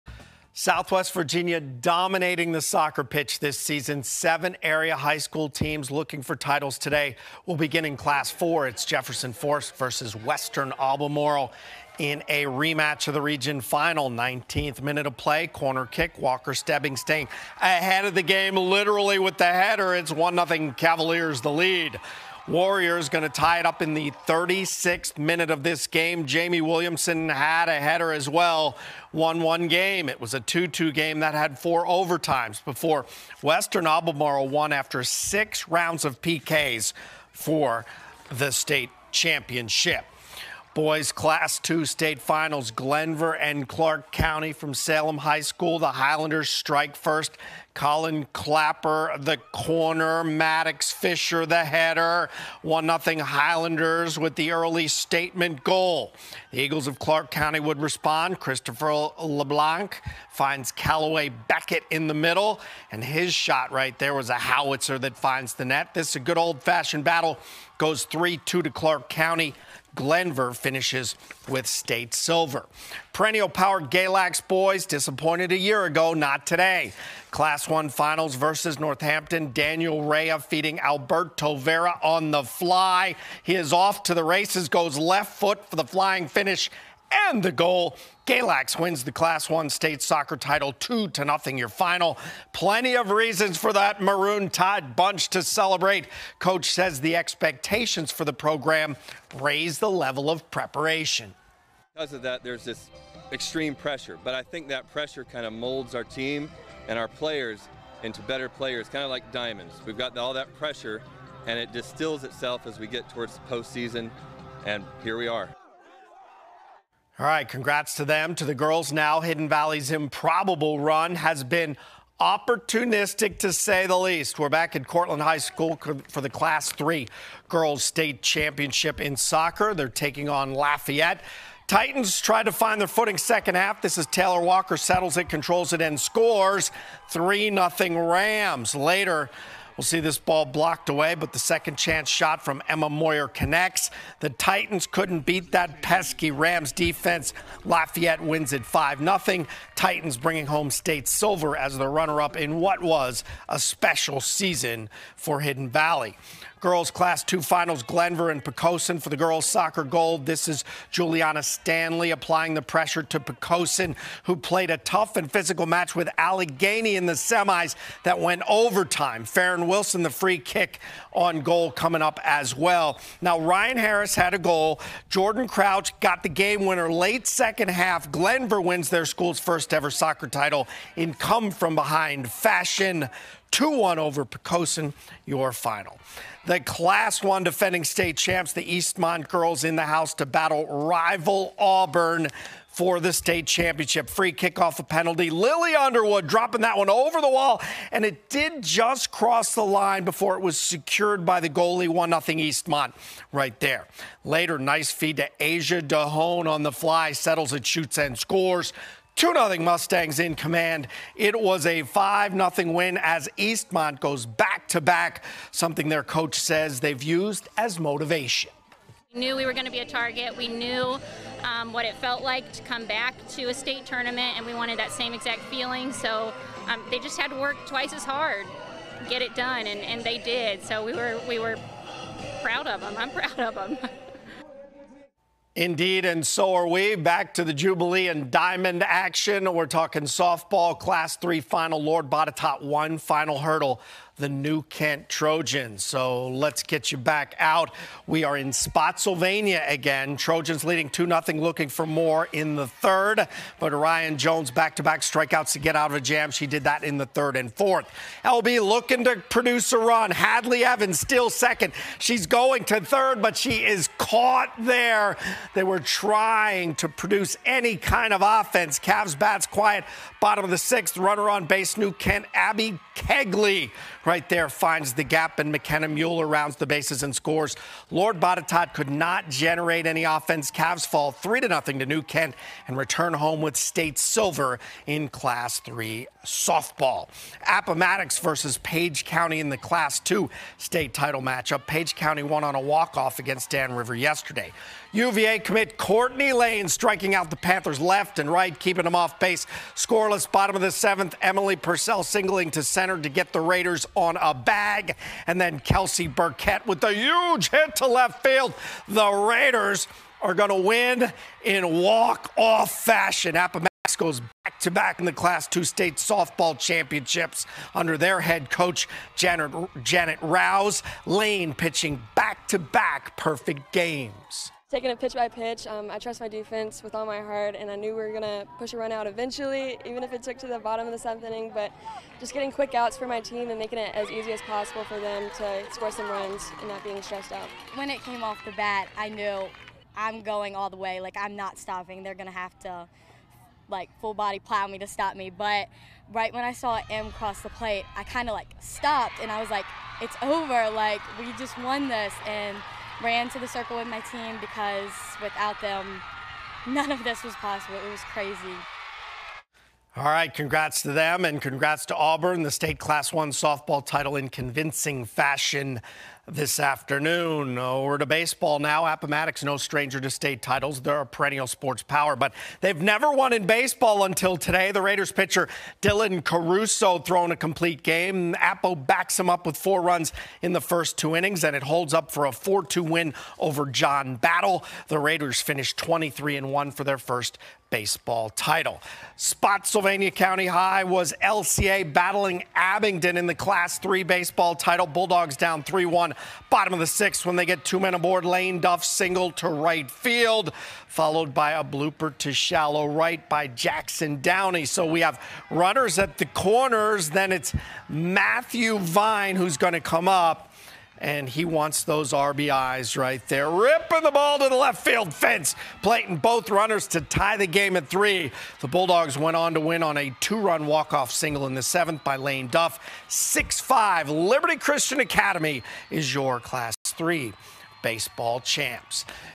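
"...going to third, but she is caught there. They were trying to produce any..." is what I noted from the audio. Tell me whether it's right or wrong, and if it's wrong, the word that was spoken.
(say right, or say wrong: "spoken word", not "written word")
right.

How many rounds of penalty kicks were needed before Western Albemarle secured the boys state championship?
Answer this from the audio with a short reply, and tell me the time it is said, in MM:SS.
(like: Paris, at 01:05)
6, at 00:35.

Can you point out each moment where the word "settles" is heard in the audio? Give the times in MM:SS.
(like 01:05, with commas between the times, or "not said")
02:14, 03:27.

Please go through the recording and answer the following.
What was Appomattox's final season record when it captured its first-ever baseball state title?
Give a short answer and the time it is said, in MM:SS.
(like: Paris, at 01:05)
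23-1, at 06:25.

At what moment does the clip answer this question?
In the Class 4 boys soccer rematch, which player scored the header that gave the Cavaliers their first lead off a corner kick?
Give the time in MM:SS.
00:16.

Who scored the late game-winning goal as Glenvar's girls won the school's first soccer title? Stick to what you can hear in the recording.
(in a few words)
Jordan Crouch.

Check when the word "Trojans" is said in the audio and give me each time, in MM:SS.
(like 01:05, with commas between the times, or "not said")
04:05, 04:10.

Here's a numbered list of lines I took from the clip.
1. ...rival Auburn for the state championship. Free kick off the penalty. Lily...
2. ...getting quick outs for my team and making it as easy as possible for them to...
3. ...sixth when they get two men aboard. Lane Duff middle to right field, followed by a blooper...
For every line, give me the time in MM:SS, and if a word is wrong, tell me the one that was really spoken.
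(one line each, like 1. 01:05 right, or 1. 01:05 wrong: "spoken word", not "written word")
1. 03:10 right
2. 05:32 right
3. 06:36 wrong: "single", not "middle".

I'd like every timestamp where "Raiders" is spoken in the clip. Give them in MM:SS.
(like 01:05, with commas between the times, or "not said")
05:03, 05:09, 06:14, 06:24.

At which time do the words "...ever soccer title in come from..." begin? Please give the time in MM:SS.
02:59.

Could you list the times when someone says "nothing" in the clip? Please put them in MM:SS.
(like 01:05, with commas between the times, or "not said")
01:31, 02:17, 04:41.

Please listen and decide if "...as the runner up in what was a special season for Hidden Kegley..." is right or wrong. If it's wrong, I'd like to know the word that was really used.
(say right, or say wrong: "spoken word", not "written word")
wrong: "Valley", not "Kegley".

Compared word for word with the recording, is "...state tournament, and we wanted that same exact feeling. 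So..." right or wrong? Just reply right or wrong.
right.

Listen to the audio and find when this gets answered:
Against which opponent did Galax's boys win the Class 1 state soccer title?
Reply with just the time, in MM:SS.
01:18.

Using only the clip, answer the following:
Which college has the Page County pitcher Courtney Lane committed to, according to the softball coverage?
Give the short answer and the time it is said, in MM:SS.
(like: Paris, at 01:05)
UVA, at 04:54.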